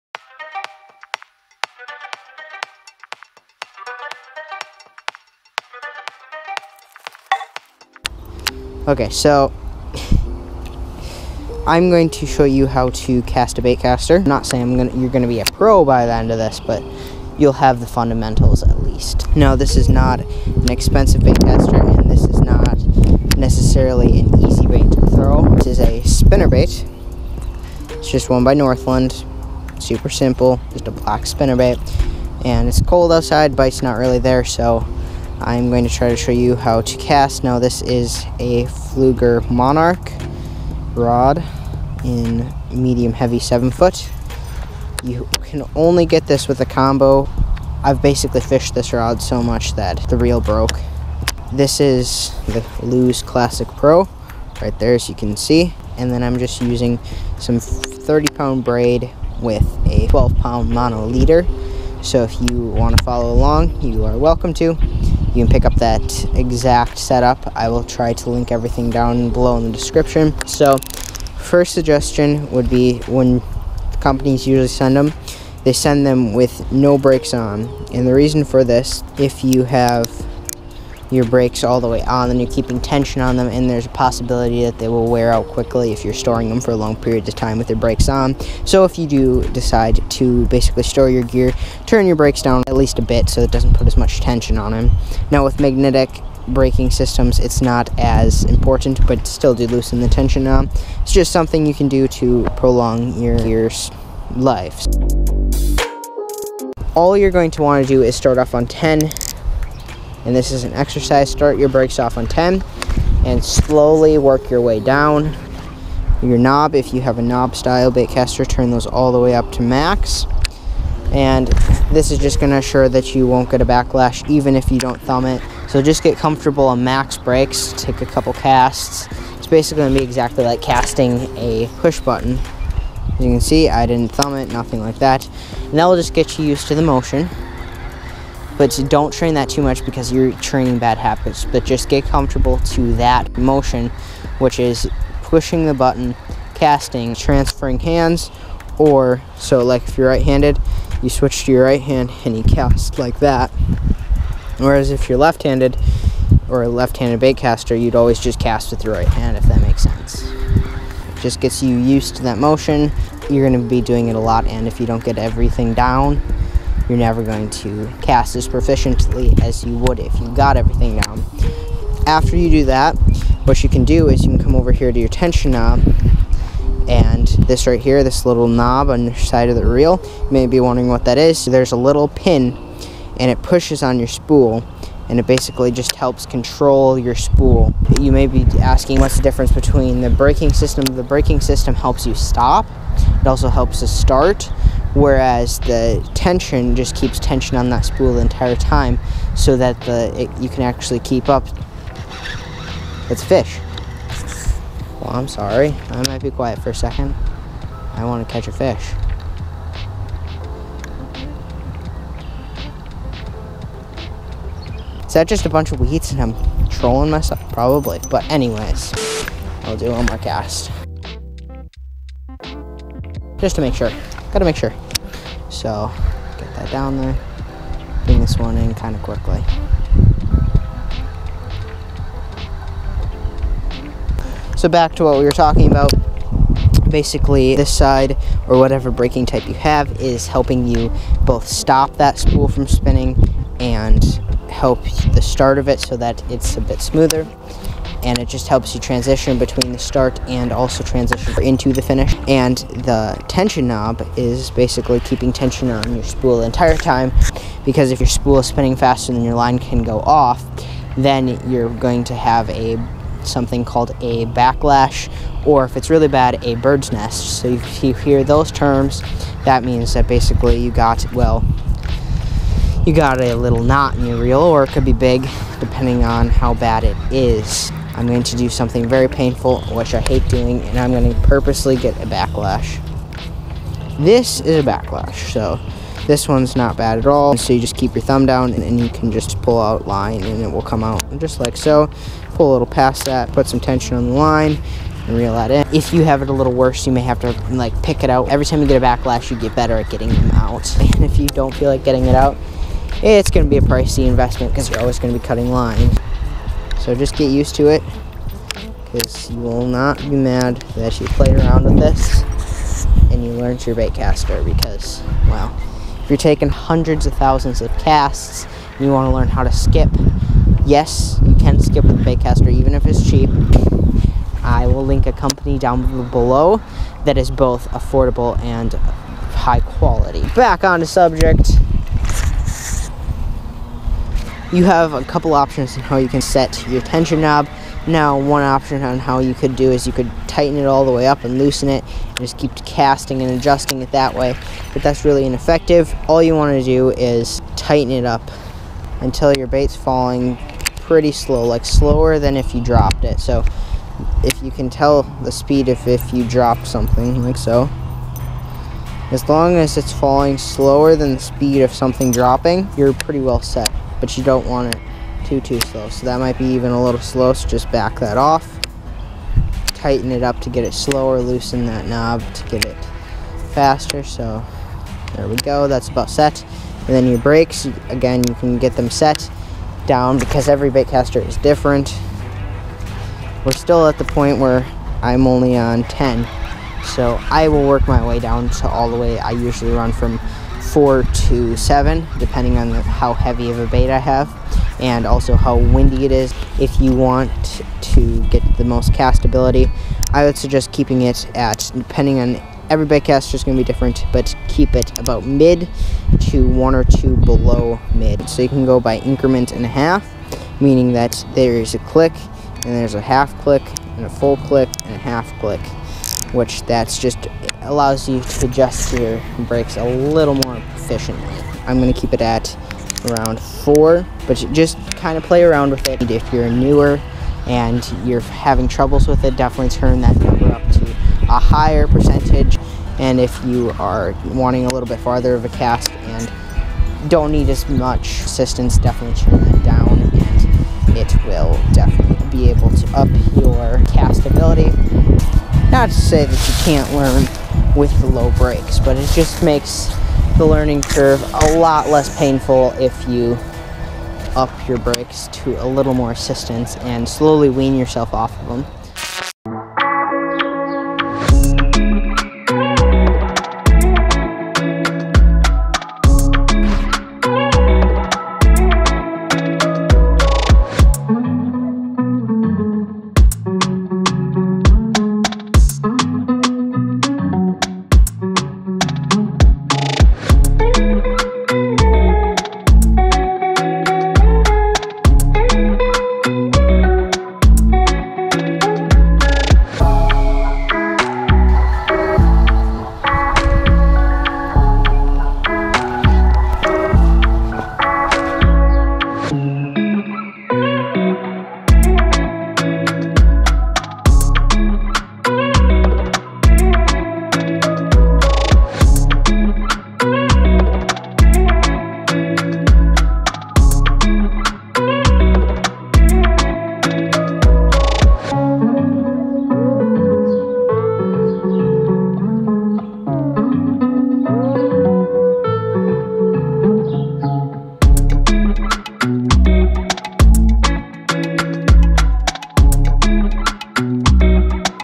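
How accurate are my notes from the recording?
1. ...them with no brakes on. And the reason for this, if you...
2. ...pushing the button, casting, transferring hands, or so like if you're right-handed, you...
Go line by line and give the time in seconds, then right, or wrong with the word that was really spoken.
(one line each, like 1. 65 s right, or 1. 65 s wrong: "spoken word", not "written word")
1. 76 s right
2. 145 s right.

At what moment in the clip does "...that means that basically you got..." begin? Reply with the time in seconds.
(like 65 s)
269 s.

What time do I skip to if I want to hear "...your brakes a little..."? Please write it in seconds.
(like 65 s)
418 s.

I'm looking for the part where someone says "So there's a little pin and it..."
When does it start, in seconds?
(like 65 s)
181 s.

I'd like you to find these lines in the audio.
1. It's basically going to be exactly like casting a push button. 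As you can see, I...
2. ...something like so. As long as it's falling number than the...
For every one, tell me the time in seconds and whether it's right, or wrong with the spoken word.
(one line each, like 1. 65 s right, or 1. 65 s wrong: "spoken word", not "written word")
1. 129 s right
2. 356 s wrong: "slower", not "number".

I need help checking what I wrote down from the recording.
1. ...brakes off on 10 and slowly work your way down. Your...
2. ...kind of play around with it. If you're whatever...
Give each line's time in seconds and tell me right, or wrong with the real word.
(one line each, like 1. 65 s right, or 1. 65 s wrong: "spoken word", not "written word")
1. 111 s right
2. 424 s wrong: "newer", not "whatever".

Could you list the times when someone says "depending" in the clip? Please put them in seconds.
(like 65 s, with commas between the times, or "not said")
275 s, 392 s, 401 s.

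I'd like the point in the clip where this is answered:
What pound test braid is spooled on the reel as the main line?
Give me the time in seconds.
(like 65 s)
57 s.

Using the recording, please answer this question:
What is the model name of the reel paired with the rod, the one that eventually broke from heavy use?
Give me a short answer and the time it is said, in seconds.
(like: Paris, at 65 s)
Lew's Classic Pro, at 52 s.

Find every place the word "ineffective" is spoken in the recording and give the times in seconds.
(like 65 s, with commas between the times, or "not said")
345 s.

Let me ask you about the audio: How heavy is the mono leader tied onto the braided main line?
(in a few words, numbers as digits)
12 pound.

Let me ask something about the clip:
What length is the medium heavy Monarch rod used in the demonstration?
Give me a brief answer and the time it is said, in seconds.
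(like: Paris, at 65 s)
7 foot, at 43 s.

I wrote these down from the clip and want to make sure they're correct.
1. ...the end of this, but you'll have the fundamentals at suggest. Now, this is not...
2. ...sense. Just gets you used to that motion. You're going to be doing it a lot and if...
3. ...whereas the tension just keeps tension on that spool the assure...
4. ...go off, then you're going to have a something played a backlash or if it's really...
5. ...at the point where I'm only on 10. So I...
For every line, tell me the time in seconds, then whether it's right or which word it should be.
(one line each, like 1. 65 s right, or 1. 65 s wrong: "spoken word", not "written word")
1. 16 s wrong: "least", not "suggest"
2. 159 s right
3. 194 s wrong: "entire", not "assure"
4. 259 s wrong: "called", not "played"
5. 383 s right.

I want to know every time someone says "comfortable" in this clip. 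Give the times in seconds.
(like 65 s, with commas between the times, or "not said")
126 s, 142 s.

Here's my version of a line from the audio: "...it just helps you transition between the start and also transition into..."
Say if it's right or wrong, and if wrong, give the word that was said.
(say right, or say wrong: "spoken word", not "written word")
right.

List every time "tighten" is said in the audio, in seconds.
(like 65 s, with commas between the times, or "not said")
340 s, 347 s, 369 s.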